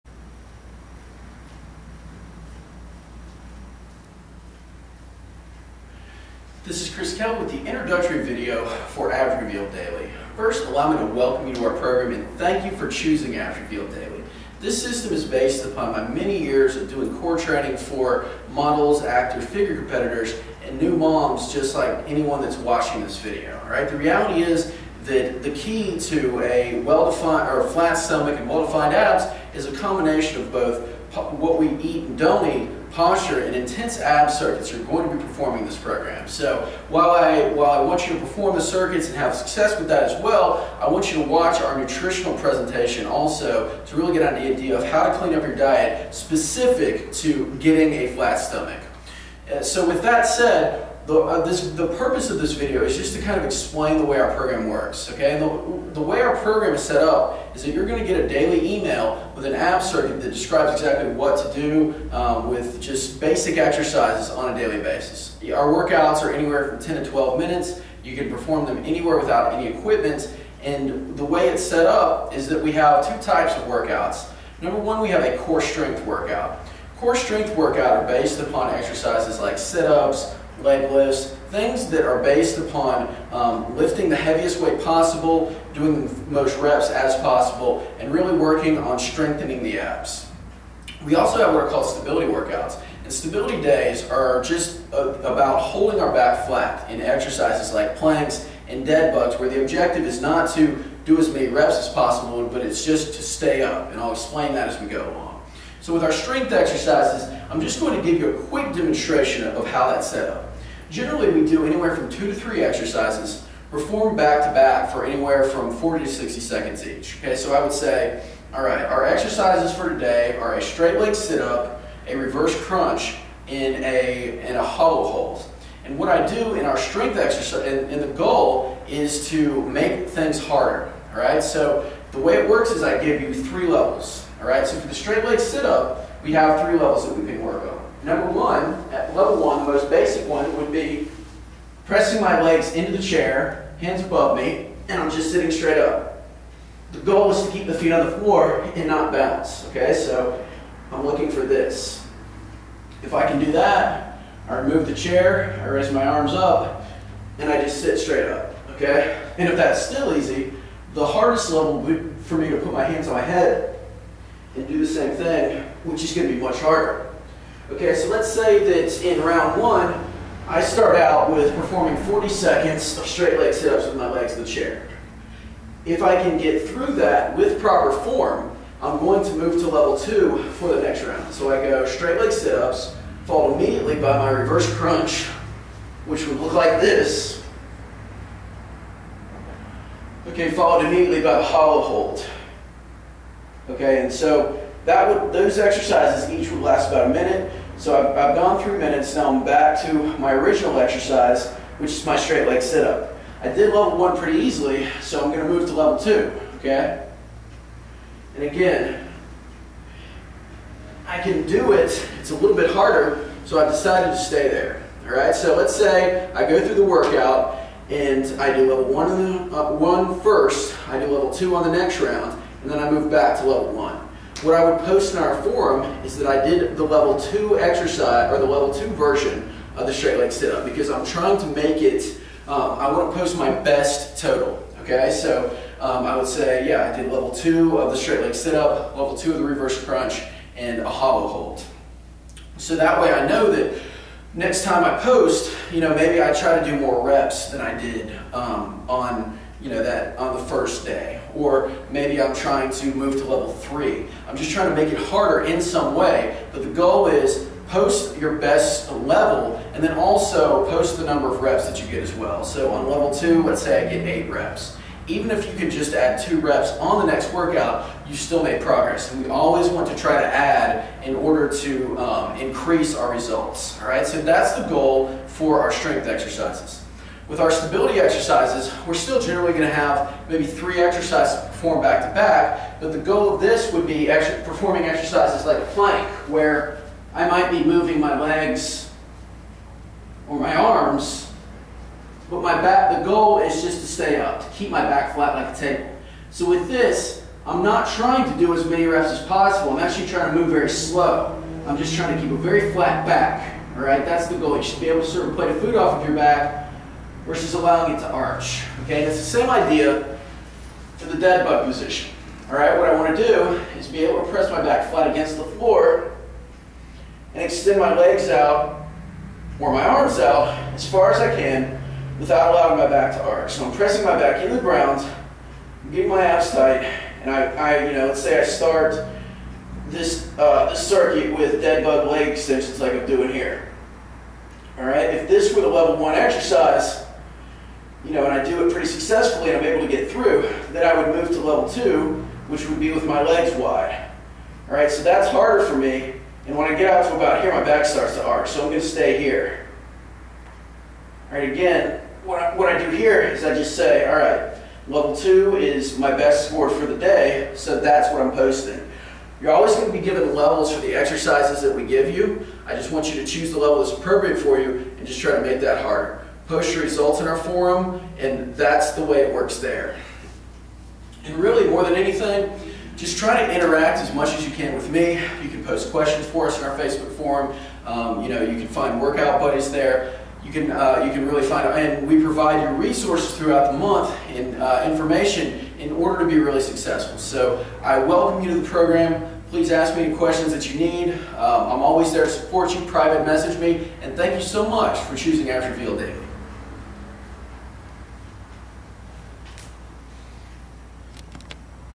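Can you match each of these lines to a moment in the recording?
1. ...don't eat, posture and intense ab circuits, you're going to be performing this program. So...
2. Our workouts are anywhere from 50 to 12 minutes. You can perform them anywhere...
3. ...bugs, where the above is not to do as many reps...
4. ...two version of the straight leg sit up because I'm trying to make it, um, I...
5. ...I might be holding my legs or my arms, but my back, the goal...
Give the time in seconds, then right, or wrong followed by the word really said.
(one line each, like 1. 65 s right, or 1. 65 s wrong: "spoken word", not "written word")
1. 32 s right
2. 65 s wrong: "10", not "50"
3. 99 s wrong: "objective", not "above"
4. 228 s right
5. 287 s wrong: "moving", not "holding".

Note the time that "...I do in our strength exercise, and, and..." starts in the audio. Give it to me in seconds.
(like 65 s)
126 s.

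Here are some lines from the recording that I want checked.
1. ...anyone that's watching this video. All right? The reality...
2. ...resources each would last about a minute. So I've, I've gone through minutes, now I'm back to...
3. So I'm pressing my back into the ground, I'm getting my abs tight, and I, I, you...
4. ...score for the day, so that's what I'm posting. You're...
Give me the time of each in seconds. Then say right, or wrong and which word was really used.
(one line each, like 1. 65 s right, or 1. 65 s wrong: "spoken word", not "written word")
1. 22 s right
2. 195 s wrong: "exercises", not "resources"
3. 323 s right
4. 356 s right.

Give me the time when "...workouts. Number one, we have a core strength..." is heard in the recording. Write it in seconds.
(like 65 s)
73 s.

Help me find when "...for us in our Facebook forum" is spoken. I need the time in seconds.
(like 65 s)
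376 s.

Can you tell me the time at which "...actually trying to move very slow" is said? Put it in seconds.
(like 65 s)
299 s.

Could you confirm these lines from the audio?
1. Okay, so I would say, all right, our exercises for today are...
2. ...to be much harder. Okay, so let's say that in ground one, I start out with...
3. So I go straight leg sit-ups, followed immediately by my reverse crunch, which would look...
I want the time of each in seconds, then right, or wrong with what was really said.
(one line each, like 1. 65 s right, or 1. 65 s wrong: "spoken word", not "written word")
1. 117 s right
2. 166 s wrong: "round", not "ground"
3. 181 s right.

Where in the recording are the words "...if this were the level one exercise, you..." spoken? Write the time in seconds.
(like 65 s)
335 s.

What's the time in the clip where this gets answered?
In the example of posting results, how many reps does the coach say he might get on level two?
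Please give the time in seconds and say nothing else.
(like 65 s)
264 s.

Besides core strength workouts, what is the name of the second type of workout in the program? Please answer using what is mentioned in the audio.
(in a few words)
Stability workouts.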